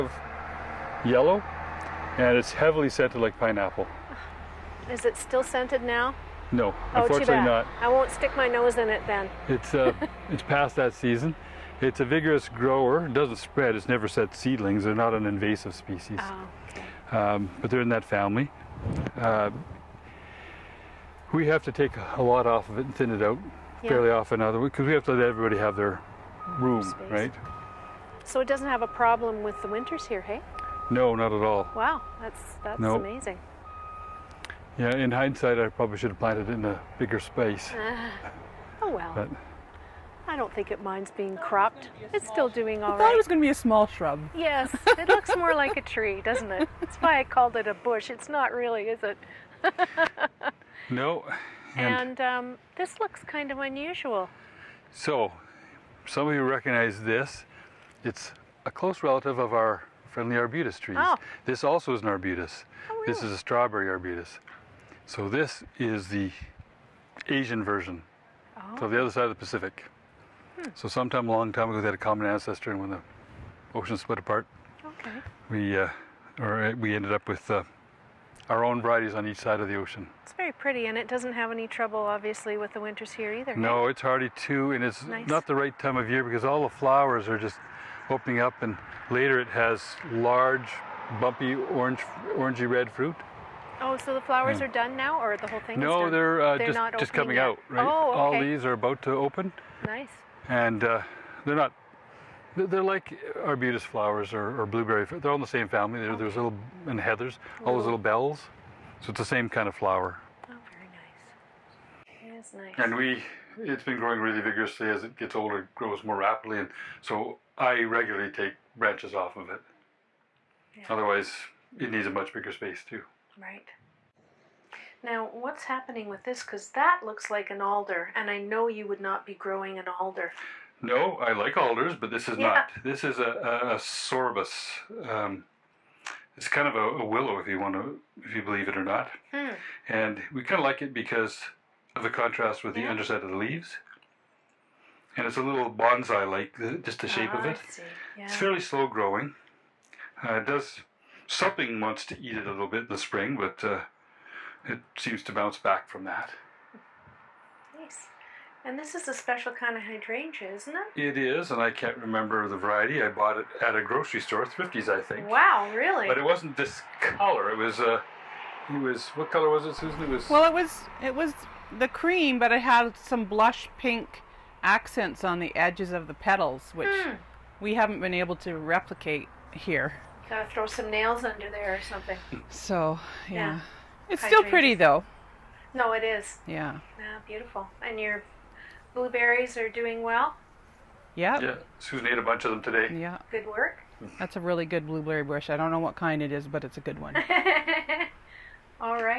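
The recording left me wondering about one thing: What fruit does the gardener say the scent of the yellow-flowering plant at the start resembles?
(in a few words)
Pineapple.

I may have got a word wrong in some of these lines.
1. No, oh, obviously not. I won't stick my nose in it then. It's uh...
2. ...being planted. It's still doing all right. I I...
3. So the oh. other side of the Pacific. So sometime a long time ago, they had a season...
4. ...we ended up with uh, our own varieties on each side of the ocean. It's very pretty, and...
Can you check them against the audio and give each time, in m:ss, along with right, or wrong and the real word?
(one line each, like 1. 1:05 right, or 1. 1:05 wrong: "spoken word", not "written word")
1. 0:06 wrong: "unfortunately", not "obviously"
2. 0:41 wrong: "cropped", not "planted"
3. 1:08 wrong: "common", not "season"
4. 1:16 right.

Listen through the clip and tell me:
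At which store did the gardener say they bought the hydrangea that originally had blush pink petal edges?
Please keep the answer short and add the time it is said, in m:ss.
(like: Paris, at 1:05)
Thrifty's, at 2:44.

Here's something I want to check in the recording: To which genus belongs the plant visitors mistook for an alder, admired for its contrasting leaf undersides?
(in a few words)
Sorbus.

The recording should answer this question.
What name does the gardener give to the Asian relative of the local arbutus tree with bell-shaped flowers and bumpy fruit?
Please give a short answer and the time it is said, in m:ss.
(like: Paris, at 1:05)
Strawberry arbutus, at 1:03.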